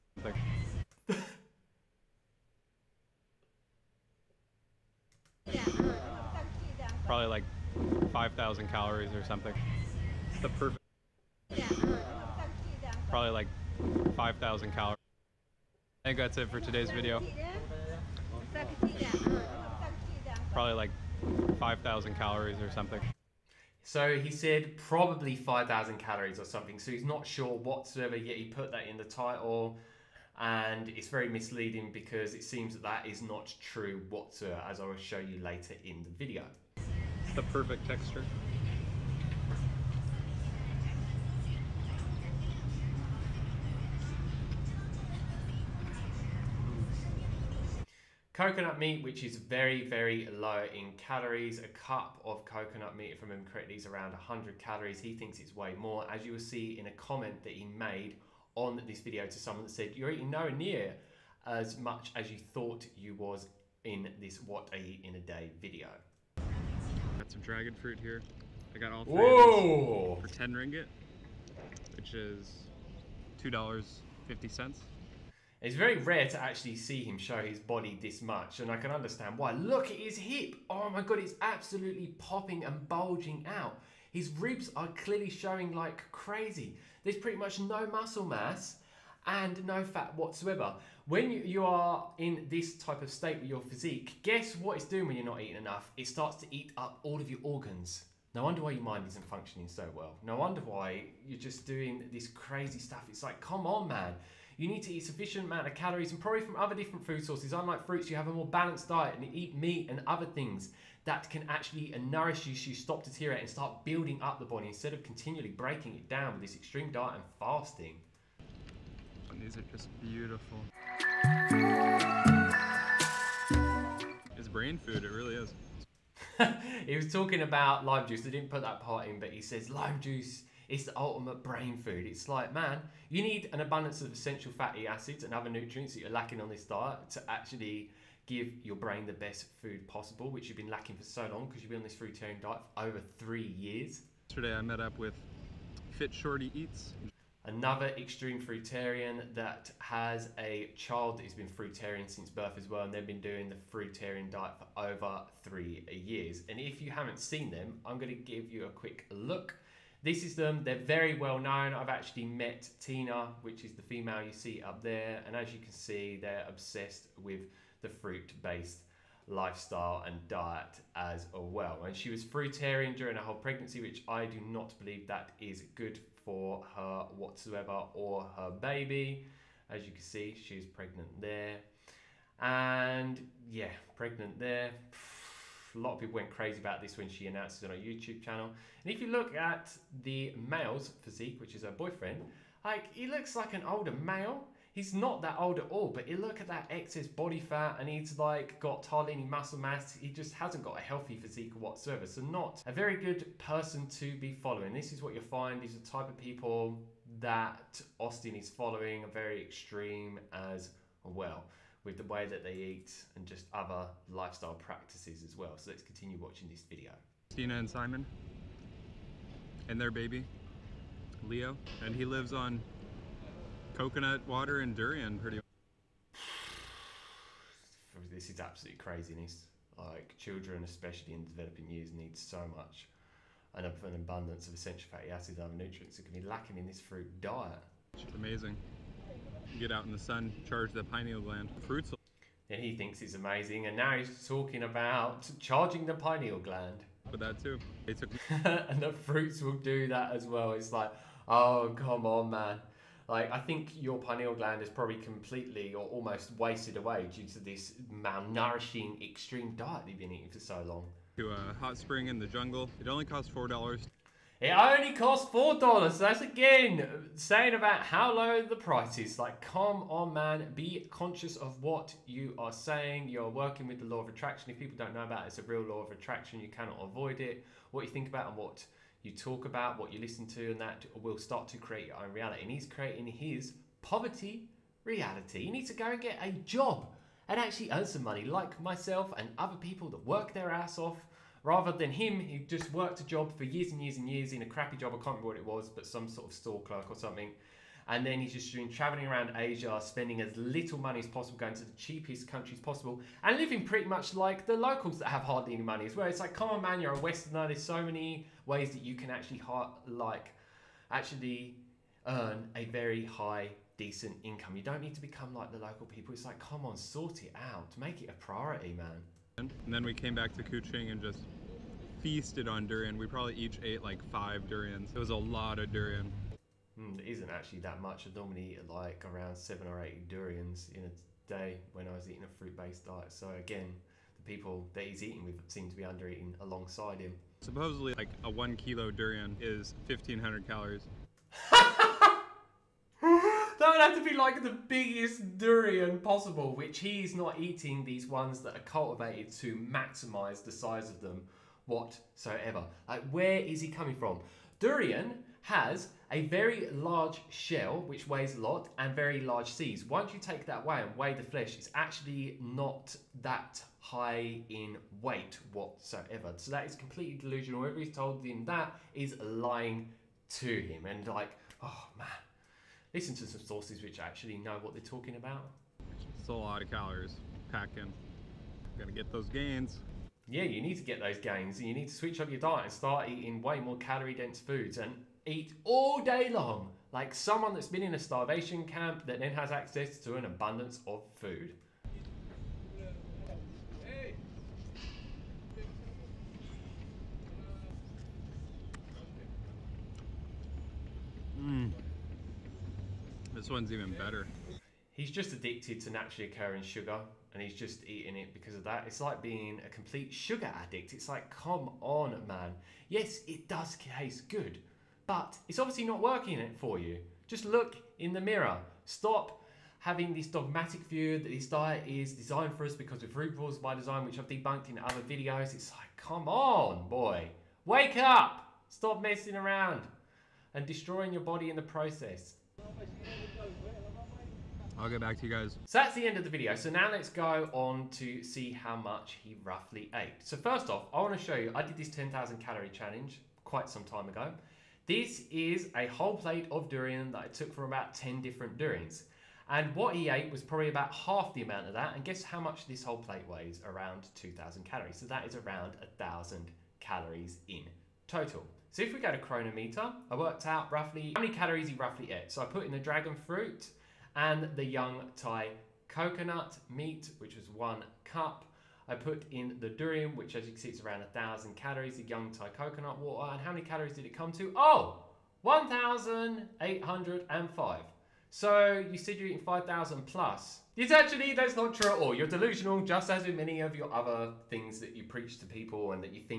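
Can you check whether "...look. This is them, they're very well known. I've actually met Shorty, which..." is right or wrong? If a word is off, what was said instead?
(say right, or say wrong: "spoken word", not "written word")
wrong: "Tina", not "Shorty".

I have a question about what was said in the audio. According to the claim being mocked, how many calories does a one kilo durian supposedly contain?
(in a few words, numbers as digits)
1,500.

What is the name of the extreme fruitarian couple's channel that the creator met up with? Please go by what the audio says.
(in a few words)
Fit Shorty Eats.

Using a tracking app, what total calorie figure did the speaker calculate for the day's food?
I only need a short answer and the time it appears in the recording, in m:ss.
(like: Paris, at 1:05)
1,805, at 7:55.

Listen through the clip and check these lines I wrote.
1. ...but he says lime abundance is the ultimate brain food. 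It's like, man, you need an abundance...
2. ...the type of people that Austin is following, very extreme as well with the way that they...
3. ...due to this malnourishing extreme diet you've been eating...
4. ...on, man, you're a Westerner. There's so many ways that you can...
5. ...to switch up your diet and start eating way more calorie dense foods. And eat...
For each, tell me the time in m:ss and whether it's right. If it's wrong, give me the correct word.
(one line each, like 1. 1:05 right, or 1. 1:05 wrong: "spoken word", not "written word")
1. 2:09 wrong: "juice", not "abundance"
2. 3:25 right
3. 4:17 right
4. 5:06 right
5. 6:21 right.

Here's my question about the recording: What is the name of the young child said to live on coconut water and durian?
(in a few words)
Leo.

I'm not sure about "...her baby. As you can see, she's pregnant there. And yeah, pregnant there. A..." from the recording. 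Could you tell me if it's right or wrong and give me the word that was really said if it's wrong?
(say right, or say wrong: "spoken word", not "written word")
right.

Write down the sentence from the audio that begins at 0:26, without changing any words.
So he's not sure whatsoever, yet he put that in the title.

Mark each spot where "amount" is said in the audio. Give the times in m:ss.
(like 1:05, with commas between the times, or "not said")
1:45, 7:31.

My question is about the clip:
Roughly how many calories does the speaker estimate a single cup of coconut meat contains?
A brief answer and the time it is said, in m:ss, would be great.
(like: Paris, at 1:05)
100 calories, at 0:54.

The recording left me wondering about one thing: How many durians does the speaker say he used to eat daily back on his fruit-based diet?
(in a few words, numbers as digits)
7 or 8.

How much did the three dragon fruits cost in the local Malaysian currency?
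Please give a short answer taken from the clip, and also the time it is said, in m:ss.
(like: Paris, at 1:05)
10 ringgit, at 1:10.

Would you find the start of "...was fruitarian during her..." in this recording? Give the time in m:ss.
2:52.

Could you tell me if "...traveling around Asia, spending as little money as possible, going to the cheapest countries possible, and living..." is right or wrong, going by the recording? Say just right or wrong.
right.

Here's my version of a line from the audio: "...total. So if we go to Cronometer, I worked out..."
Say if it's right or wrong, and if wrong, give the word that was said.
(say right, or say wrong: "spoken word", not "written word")
right.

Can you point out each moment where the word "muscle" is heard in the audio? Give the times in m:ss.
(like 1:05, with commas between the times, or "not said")
1:27, 3:19.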